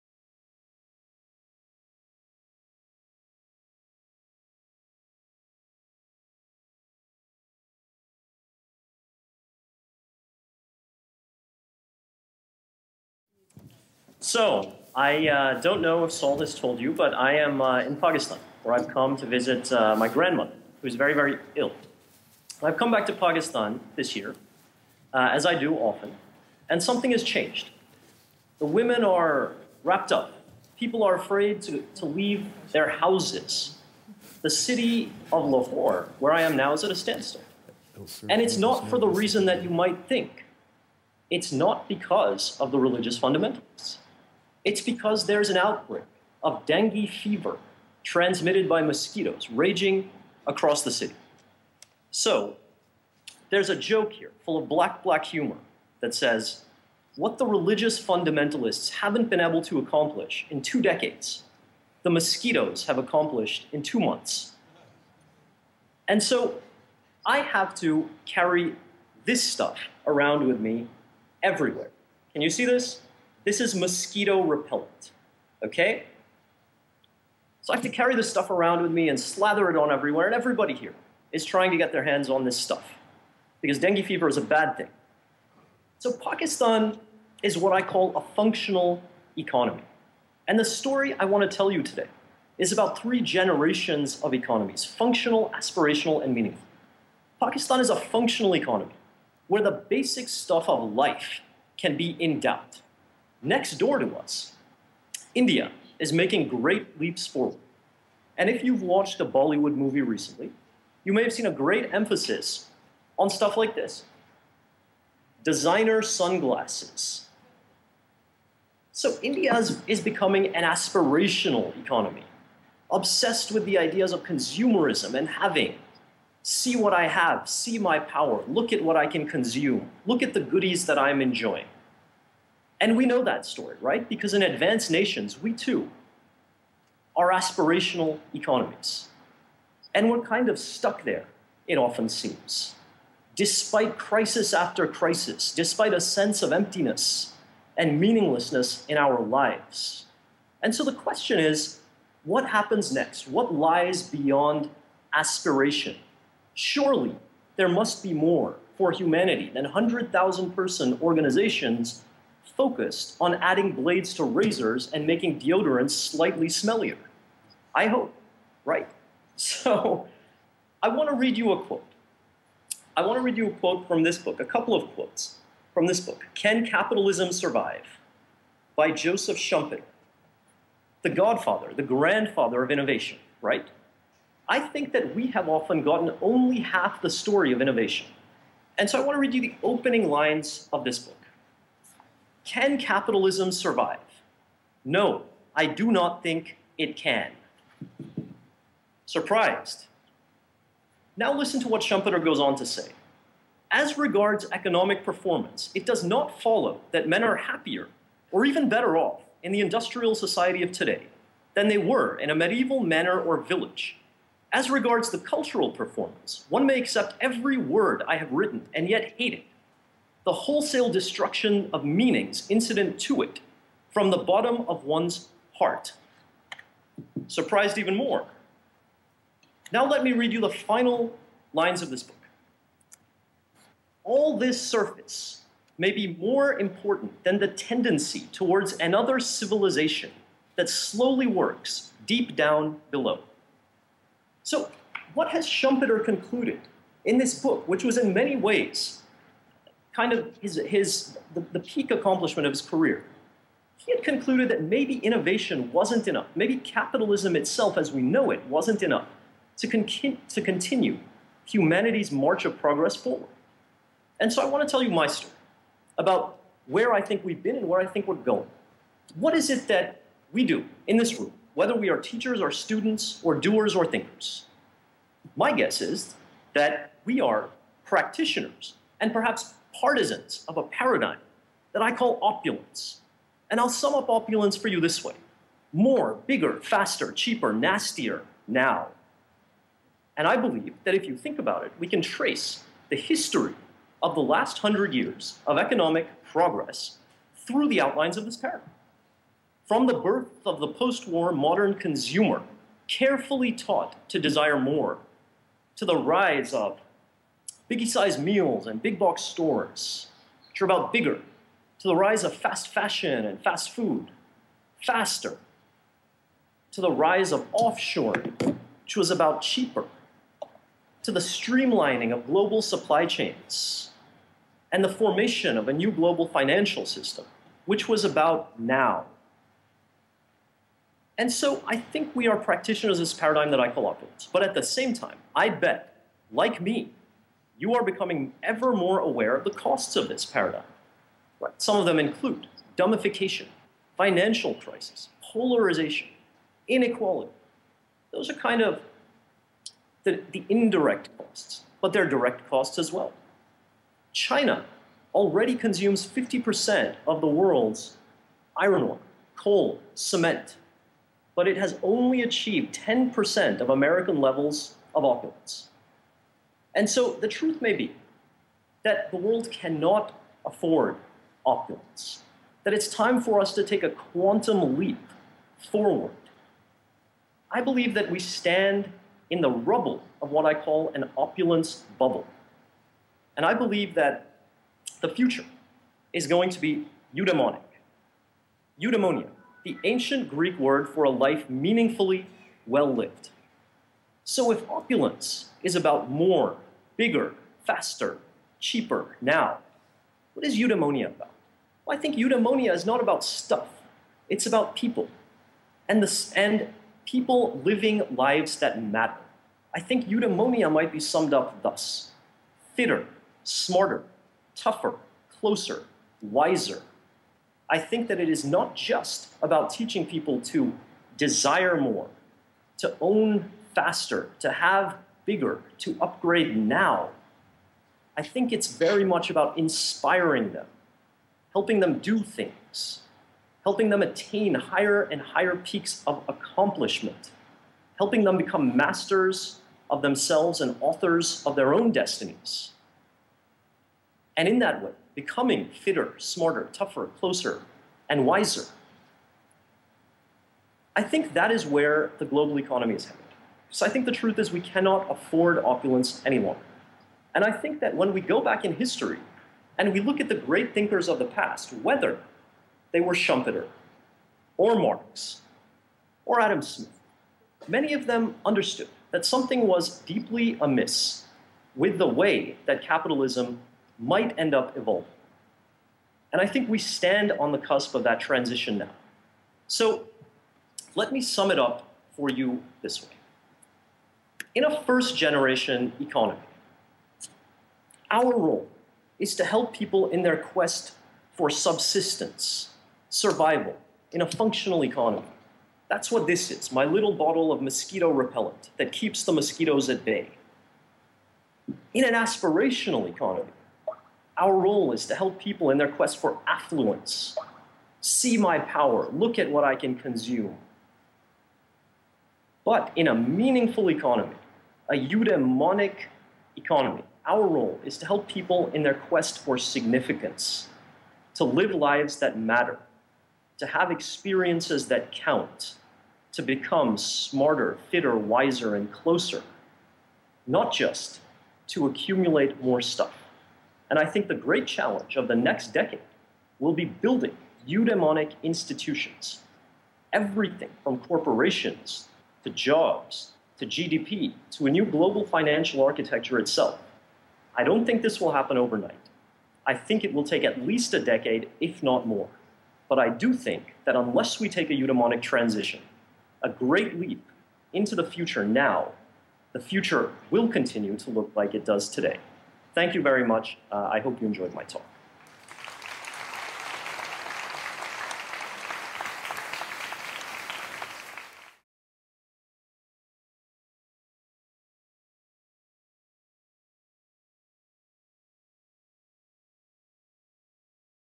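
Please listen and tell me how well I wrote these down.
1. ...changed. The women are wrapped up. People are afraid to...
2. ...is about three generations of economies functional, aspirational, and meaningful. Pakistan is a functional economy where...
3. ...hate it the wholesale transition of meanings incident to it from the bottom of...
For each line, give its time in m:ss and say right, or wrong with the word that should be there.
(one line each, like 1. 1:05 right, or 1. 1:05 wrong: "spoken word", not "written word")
1. 0:27 right
2. 1:32 right
3. 3:39 wrong: "destruction", not "transition".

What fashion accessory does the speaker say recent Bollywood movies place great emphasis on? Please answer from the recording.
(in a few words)
Designer sunglasses.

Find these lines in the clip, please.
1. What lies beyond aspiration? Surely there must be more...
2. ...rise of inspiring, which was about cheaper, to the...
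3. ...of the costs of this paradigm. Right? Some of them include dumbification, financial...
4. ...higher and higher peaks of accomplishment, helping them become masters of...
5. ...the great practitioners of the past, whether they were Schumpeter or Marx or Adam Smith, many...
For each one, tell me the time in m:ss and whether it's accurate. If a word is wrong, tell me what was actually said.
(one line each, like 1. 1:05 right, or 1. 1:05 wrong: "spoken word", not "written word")
1. 2:33 right
2. 5:16 wrong: "offshoring", not "inspiring"
3. 5:39 right
4. 7:14 right
5. 7:40 wrong: "thinkers", not "practitioners".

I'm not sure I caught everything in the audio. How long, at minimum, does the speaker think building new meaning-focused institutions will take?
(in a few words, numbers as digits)
A decade.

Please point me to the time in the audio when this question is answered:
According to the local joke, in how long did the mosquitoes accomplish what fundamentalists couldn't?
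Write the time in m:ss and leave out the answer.
1:03.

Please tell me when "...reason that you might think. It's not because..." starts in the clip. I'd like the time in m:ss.
0:39.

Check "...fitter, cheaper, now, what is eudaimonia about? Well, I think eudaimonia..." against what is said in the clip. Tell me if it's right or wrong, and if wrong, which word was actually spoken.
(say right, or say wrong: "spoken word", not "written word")
wrong: "faster", not "fitter".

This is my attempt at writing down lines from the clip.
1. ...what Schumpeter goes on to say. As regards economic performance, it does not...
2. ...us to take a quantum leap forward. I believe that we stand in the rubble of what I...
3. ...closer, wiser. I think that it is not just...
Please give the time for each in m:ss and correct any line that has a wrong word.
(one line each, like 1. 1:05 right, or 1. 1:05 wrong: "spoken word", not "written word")
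1. 3:21 right
2. 6:13 right
3. 6:55 right.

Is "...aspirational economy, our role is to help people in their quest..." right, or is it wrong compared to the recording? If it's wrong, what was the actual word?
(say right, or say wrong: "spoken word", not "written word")
right.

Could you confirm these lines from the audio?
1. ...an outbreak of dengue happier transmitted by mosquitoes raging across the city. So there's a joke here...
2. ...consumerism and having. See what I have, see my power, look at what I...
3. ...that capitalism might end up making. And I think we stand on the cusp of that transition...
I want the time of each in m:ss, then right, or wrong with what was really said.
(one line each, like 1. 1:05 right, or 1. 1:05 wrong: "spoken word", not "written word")
1. 0:45 wrong: "fever", not "happier"
2. 2:04 right
3. 7:52 wrong: "evolving", not "making".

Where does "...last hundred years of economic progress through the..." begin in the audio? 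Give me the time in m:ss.
4:54.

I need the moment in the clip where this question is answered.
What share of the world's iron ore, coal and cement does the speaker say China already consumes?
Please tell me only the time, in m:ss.
5:56.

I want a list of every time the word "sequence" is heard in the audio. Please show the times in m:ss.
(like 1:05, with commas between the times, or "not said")
not said.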